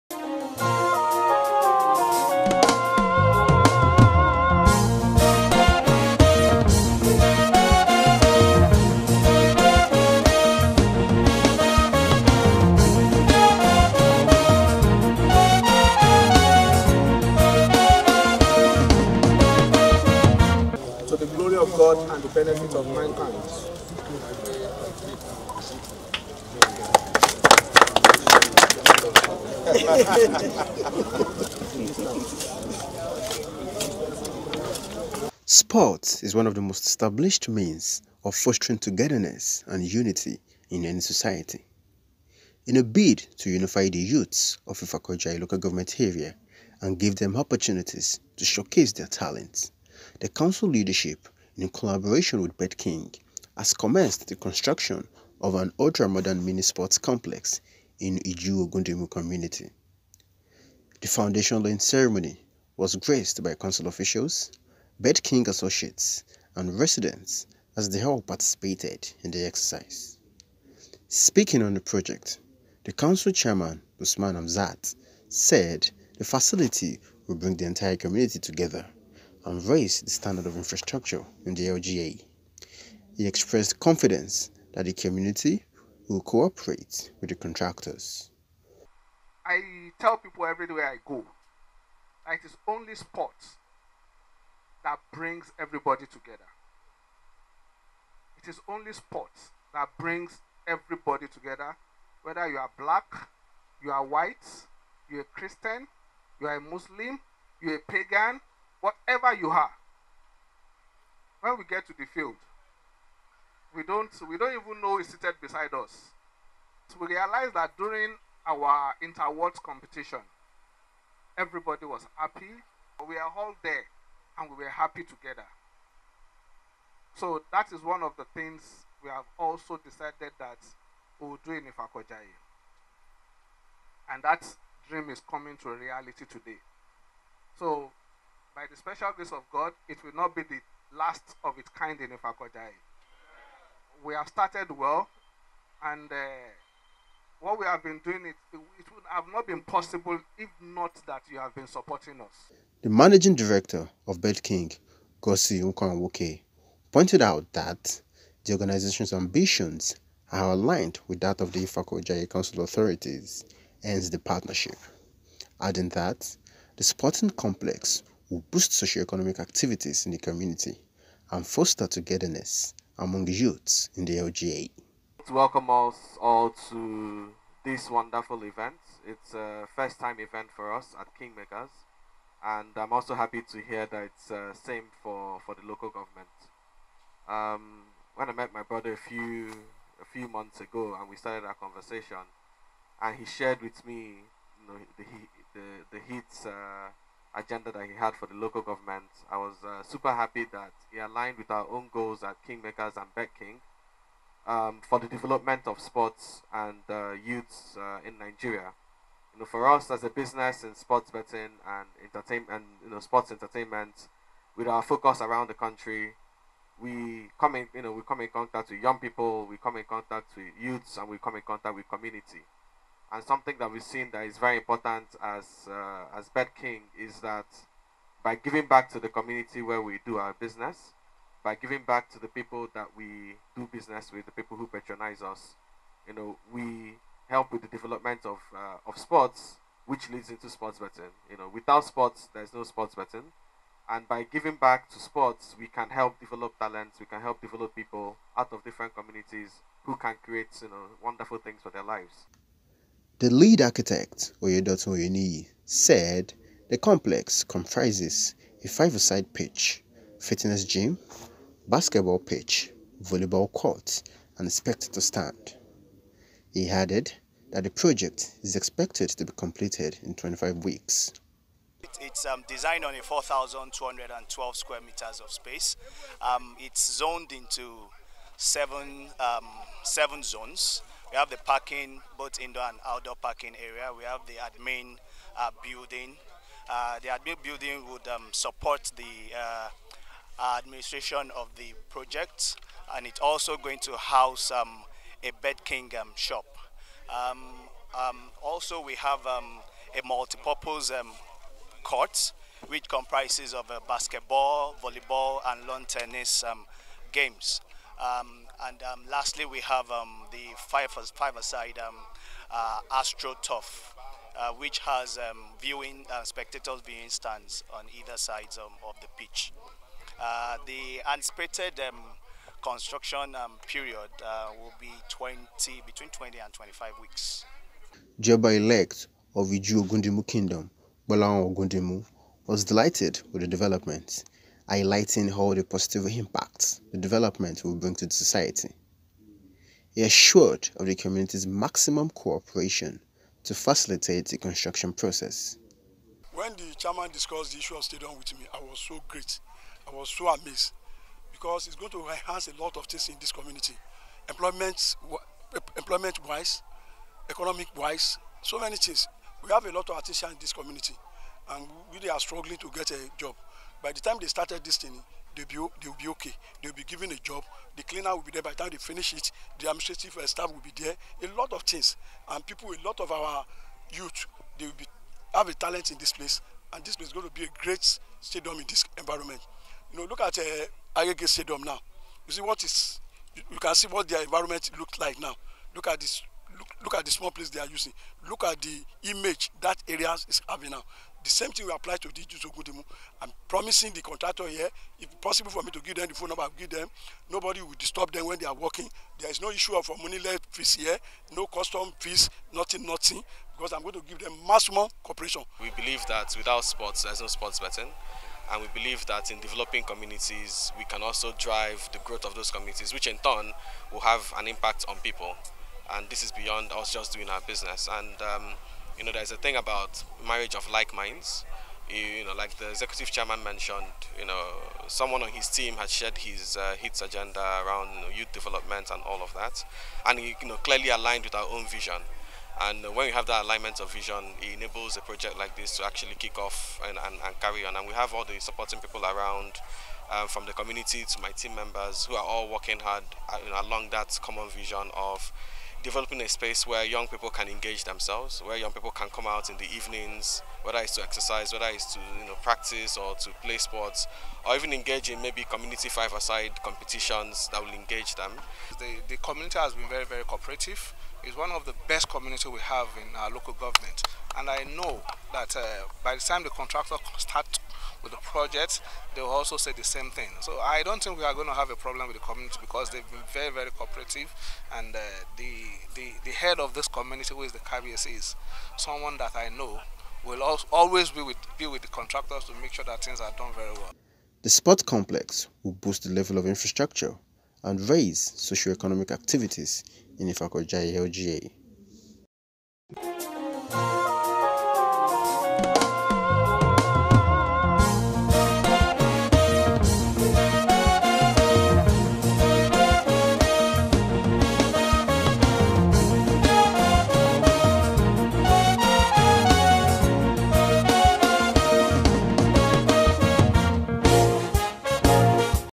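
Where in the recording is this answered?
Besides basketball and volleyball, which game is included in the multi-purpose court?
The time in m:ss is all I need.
5:05.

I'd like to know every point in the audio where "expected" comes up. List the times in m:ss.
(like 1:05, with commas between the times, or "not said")
4:24, 4:28.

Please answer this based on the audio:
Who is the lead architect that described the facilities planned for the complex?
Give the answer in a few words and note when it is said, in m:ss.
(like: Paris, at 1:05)
Oyedotun Oyeni, at 4:14.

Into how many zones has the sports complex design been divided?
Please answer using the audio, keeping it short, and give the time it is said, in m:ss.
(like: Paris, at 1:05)
7, at 4:39.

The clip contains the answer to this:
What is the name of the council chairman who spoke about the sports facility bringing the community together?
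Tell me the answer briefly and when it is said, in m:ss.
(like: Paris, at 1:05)
Usman Hamzat, at 1:14.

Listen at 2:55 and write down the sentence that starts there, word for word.
welcome us all to this wonderful event.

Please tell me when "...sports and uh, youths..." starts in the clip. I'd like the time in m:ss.
3:25.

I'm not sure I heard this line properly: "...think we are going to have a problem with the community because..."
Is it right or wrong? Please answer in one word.
right.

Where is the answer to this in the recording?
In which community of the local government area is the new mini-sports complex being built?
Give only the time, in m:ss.
0:58.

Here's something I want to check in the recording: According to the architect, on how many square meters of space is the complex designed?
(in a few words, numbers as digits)
4,212.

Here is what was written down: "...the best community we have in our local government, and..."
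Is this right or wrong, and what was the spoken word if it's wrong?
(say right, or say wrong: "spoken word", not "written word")
right.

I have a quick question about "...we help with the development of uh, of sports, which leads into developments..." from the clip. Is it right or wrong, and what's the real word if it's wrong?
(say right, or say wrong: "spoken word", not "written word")
wrong: "sports", not "developments".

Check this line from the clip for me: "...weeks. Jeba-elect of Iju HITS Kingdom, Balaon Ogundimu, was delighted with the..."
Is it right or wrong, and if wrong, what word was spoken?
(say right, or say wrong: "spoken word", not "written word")
wrong: "Ogundimu", not "HITS".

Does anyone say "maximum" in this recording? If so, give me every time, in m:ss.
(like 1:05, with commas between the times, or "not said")
5:41, 6:44.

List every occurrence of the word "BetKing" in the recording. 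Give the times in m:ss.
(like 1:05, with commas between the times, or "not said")
0:52, 1:05, 4:55.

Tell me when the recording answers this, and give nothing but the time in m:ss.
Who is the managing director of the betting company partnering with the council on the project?
2:35.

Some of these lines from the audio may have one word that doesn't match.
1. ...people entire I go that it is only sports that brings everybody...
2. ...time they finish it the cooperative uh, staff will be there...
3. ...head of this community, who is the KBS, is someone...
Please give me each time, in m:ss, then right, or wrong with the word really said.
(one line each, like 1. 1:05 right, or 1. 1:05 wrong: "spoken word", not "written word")
1. 1:30 wrong: "everywhere", not "entire"
2. 6:08 wrong: "administrative", not "cooperative"
3. 7:56 right.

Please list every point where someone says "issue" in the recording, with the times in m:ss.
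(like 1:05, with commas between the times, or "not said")
5:47, 6:39.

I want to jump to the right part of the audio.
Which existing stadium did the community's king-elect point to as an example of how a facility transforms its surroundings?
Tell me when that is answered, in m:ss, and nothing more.
6:20.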